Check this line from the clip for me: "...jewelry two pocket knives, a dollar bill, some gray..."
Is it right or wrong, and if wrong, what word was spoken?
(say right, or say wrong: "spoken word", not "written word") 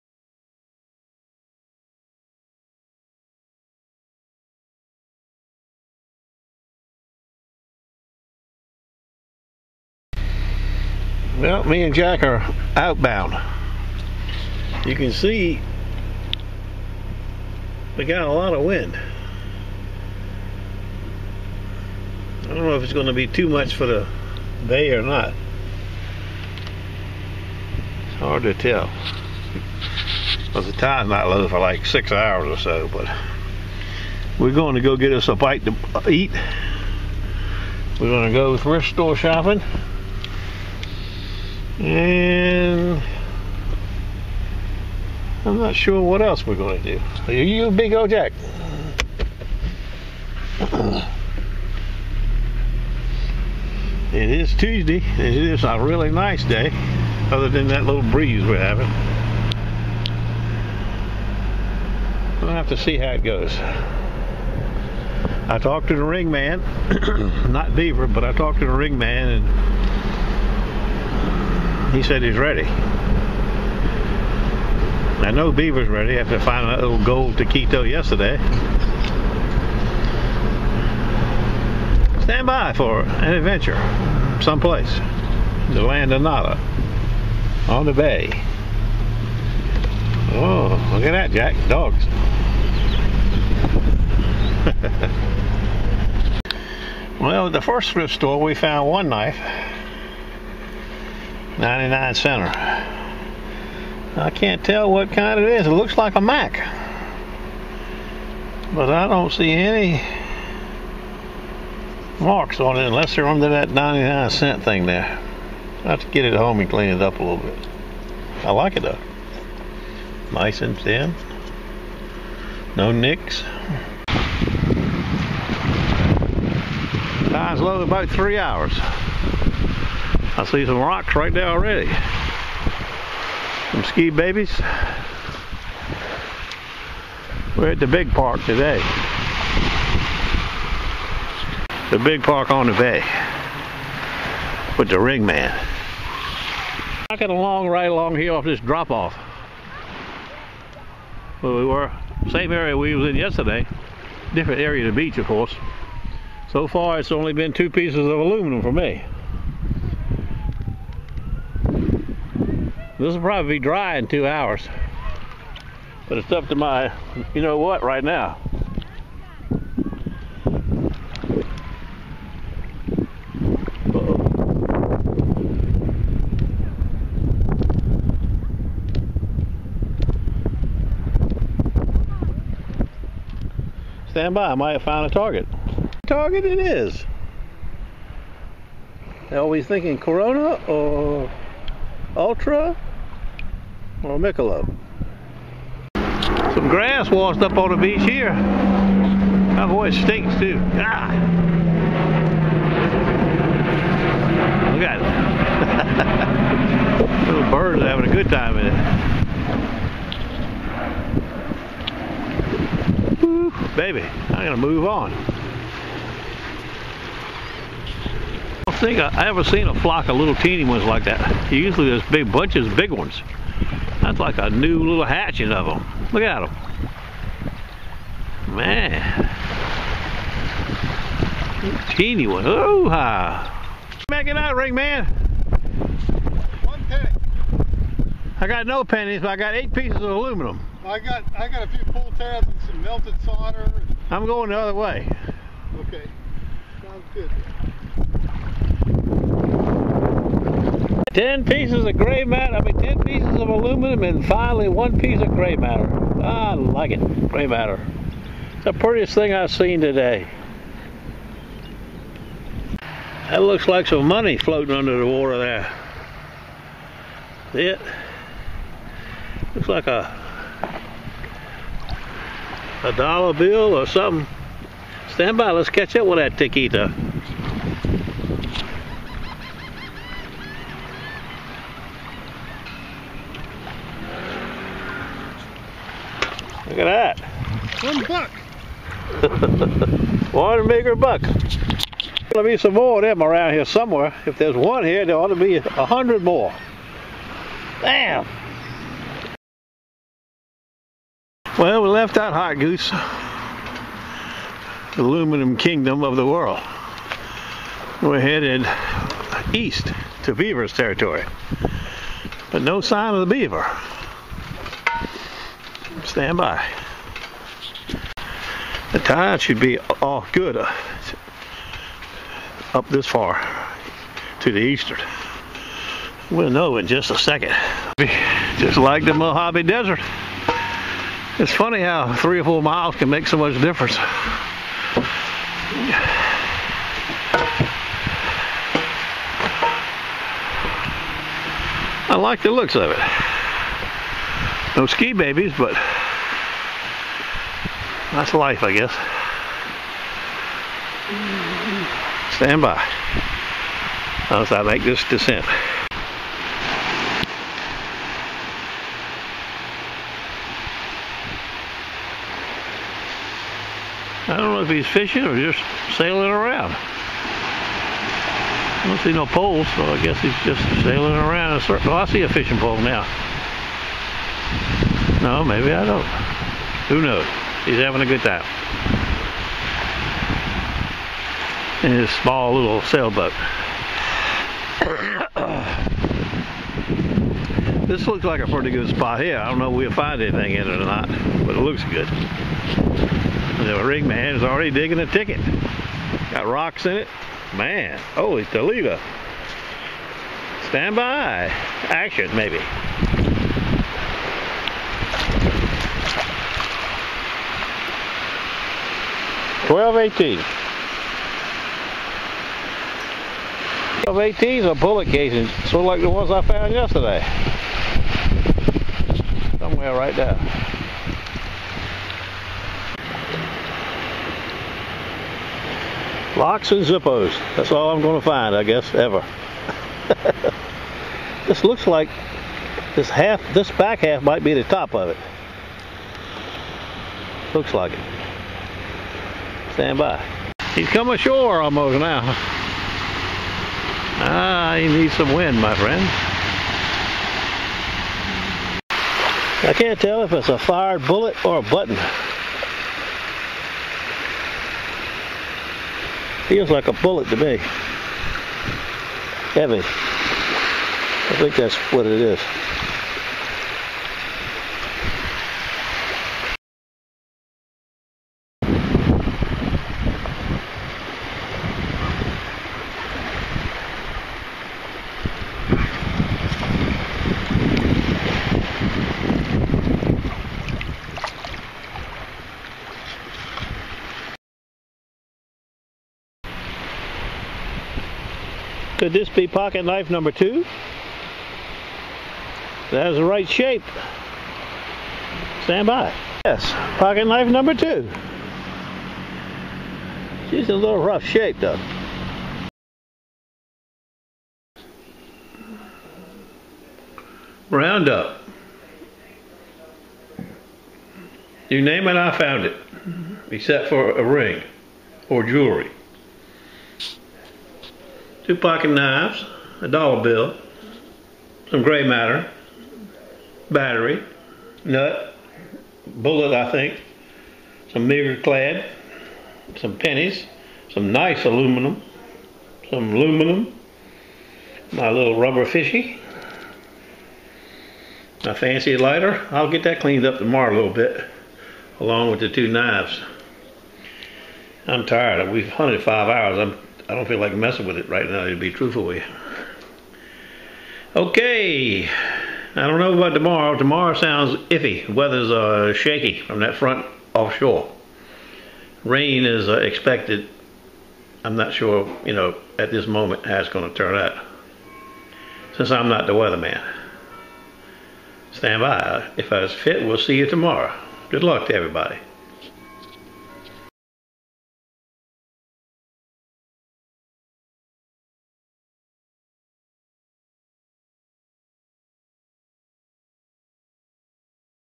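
right.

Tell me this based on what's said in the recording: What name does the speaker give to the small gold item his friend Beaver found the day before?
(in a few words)
gold taquito.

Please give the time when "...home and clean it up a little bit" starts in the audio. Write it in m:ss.
1:56.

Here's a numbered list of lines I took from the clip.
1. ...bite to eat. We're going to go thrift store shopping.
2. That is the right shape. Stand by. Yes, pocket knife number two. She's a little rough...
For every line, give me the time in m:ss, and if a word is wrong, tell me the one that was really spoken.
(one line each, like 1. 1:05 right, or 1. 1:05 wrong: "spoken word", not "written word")
1. 0:35 right
2. 8:12 right.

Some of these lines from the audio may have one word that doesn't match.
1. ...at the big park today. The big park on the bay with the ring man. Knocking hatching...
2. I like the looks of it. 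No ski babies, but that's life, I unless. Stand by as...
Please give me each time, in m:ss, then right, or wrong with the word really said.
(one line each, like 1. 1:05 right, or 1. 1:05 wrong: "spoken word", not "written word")
1. 2:17 wrong: "along", not "hatching"
2. 5:42 wrong: "guess", not "unless".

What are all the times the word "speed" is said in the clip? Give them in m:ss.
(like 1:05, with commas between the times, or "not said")
not said.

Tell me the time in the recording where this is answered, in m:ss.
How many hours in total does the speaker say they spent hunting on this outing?
9:06.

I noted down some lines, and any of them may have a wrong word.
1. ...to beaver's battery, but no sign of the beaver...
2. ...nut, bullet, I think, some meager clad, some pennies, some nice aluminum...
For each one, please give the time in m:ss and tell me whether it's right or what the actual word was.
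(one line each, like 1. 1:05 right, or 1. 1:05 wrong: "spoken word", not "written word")
1. 5:10 wrong: "territory", not "battery"
2. 8:44 right.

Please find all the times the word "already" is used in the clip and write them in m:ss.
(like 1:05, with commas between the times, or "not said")
2:11, 6:34.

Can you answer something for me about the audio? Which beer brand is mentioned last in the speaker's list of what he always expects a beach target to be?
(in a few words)
Michelob.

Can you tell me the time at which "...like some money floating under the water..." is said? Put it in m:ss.
4:23.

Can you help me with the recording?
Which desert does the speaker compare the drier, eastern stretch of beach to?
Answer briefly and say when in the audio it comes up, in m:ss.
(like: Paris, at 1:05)
Mojave Desert, at 5:29.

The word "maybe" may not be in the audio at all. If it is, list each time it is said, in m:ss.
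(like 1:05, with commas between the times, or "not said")
6:15, 6:42.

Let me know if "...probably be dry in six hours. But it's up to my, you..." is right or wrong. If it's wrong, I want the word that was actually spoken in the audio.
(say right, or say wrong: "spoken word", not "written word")
wrong: "two", not "six".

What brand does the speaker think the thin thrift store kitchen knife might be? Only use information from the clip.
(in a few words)
Mac.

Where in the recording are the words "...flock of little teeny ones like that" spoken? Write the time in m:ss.
3:39.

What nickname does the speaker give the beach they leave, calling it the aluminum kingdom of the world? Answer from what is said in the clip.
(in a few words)
Hot Goose.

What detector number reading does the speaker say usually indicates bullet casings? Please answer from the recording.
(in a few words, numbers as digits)
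1218.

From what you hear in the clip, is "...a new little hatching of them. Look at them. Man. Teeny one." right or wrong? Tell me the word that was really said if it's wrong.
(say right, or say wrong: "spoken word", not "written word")
right.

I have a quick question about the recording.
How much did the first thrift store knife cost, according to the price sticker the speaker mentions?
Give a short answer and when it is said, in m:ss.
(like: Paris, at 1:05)
99 cents, at 1:41.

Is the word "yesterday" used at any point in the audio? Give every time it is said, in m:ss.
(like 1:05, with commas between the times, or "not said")
1:17, 2:33, 6:56.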